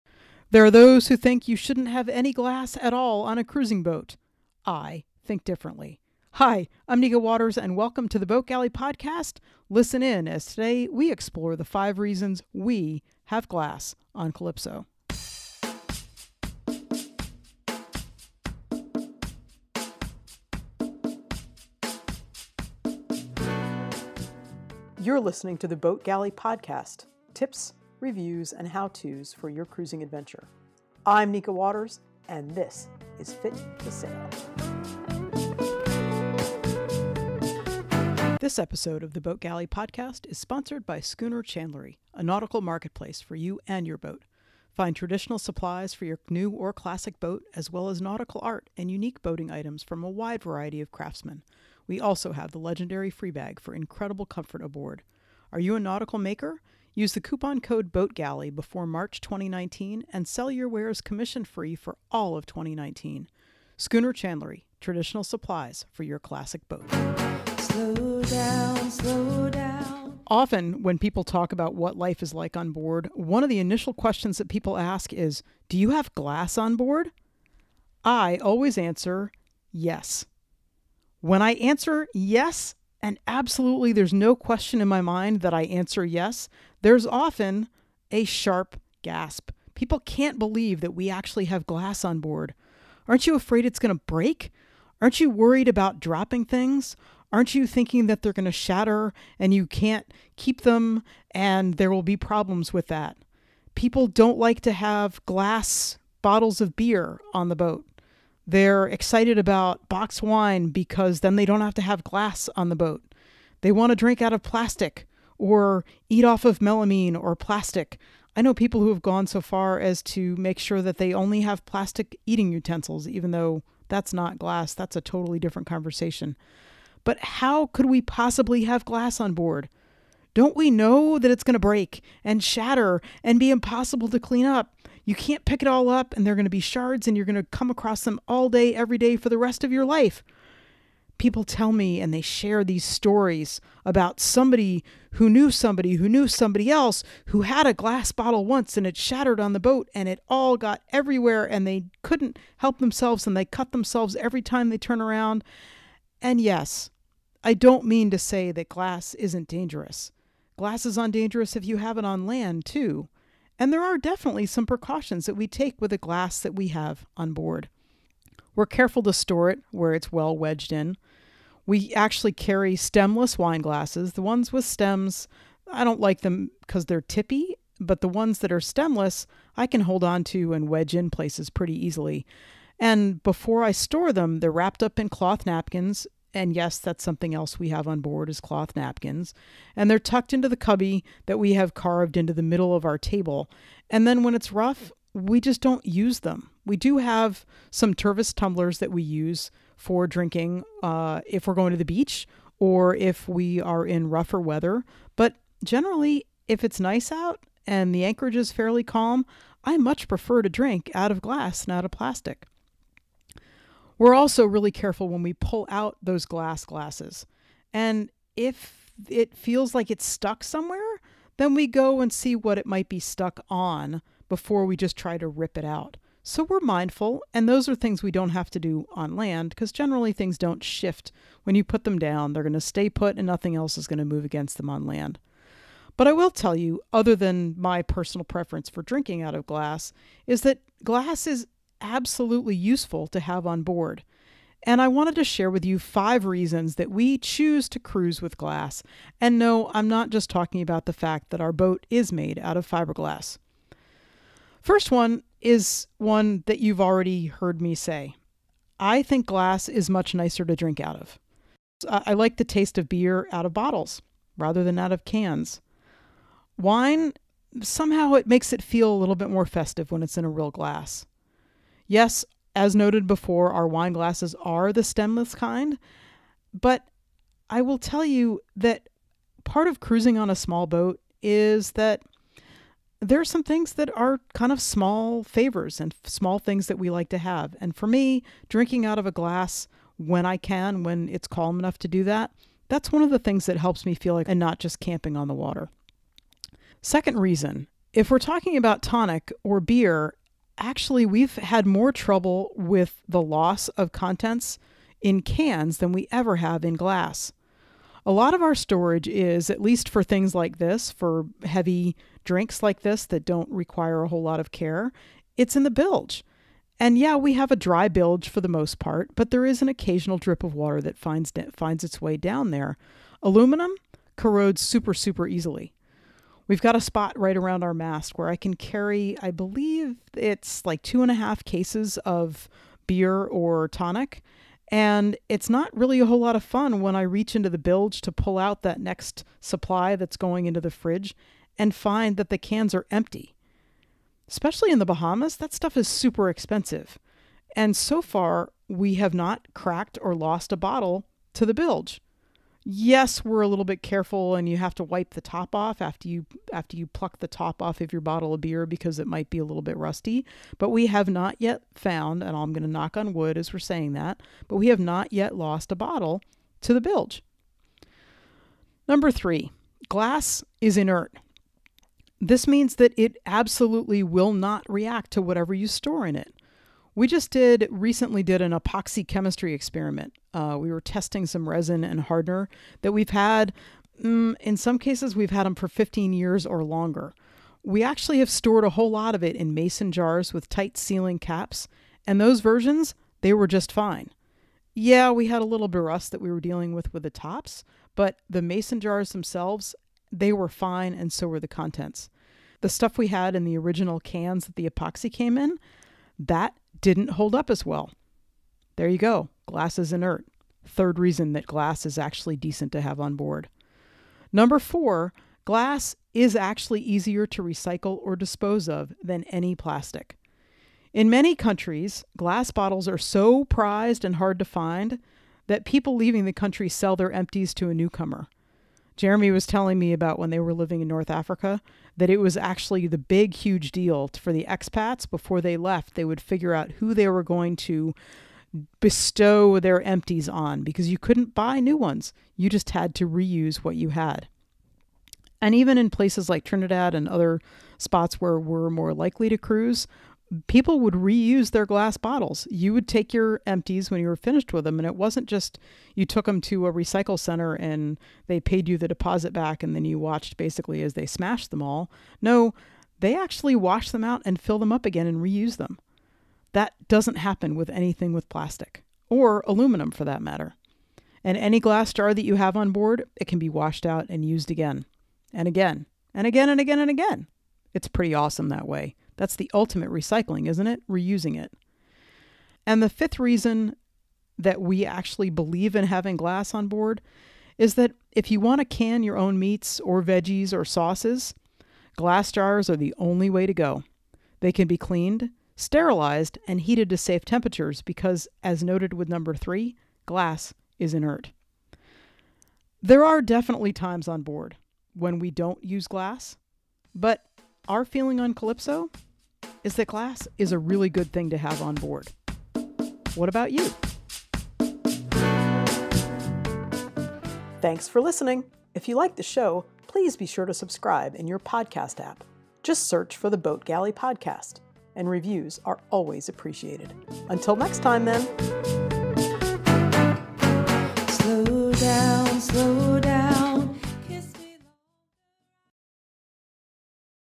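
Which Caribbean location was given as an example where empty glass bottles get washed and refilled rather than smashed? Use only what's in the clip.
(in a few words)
Trinidad.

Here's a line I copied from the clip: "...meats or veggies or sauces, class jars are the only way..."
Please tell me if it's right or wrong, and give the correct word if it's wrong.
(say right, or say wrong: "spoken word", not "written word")
wrong: "glass", not "class".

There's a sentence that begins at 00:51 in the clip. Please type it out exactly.
We also have the legendary Freebag for incredible comfort aboard.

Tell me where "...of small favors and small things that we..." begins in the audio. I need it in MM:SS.
04:44.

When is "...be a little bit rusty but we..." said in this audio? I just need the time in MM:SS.
05:59.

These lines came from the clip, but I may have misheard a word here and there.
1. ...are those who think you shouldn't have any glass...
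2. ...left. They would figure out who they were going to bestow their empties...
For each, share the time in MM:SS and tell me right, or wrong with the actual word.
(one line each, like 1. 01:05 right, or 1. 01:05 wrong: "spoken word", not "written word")
1. 00:00 right
2. 07:15 right.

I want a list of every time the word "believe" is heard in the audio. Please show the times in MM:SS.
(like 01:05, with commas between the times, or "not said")
01:30, 05:29, 08:05.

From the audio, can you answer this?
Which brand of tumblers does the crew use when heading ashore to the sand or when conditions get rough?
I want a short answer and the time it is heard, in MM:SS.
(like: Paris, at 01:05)
Tervis, at 03:17.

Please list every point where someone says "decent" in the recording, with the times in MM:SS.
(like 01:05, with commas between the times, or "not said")
06:52.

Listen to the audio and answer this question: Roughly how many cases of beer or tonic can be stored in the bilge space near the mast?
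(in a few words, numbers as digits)
2.5.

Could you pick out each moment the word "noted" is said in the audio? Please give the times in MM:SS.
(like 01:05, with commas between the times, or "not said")
04:32, 08:18.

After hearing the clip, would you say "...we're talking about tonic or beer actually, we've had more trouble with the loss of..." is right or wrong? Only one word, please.
right.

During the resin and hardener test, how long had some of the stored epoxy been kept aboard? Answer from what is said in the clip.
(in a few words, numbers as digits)
15 years.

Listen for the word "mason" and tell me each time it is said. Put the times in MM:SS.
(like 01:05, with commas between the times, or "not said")
06:29, 06:38.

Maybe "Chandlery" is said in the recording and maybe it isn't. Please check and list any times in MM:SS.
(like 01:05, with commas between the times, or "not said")
00:41, 01:04.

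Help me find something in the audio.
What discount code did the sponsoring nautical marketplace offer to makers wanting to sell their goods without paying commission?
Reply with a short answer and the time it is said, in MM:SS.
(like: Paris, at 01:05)
BOATGALLEY, at 00:57.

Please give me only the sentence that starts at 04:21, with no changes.
I like the taste of beer out of bottles rather than out of cans.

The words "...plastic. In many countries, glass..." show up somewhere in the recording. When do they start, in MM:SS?
06:59.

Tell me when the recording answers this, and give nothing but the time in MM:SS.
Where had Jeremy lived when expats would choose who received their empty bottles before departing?
07:10.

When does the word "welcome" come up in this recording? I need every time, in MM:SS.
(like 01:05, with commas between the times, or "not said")
00:07.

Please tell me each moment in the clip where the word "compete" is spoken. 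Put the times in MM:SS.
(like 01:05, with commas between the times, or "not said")
not said.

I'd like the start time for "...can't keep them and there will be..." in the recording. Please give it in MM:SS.
01:39.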